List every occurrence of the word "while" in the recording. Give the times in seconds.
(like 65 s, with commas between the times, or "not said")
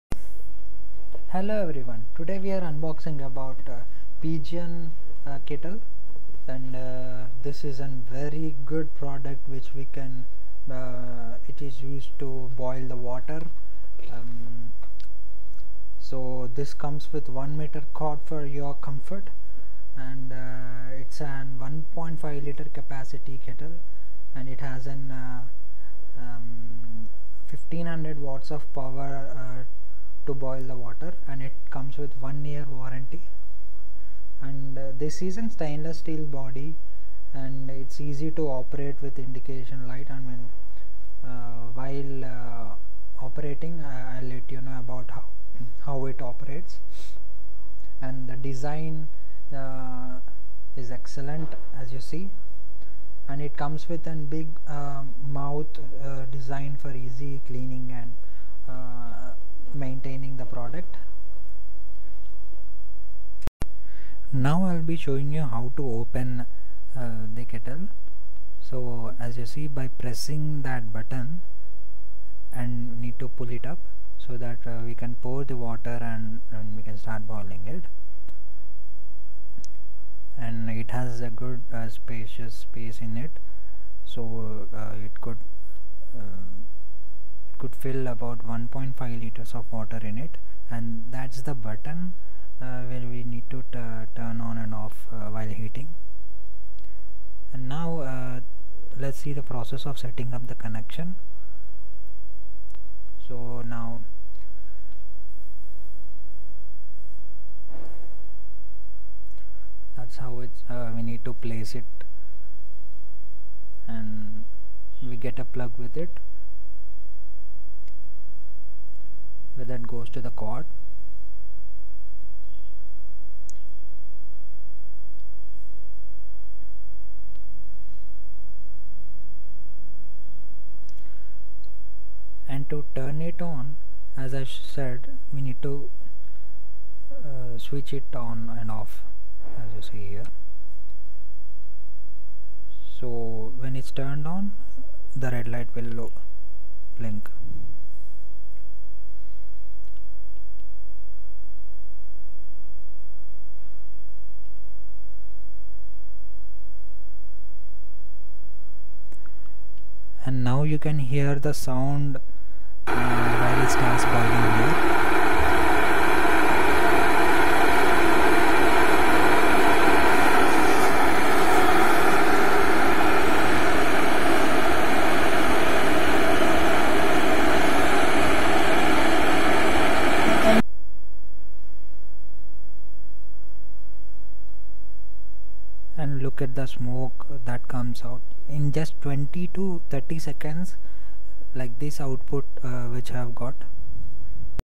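41 s, 95 s, 162 s.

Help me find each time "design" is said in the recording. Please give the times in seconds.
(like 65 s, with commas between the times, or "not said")
48 s, 56 s.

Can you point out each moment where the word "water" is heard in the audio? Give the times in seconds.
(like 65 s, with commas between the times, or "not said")
12 s, 30 s, 75 s, 89 s.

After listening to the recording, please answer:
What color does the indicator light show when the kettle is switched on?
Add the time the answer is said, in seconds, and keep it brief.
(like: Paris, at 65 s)
Red, at 145 s.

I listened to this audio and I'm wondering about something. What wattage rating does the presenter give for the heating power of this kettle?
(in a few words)
1500 watts.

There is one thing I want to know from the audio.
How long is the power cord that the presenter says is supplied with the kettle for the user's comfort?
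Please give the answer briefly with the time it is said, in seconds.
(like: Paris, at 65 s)
1 meter, at 17 s.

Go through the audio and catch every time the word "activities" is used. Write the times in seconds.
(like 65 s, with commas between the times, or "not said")
not said.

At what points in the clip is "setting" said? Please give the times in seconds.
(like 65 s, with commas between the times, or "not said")
99 s.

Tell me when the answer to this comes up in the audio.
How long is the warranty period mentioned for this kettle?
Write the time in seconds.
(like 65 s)
32 s.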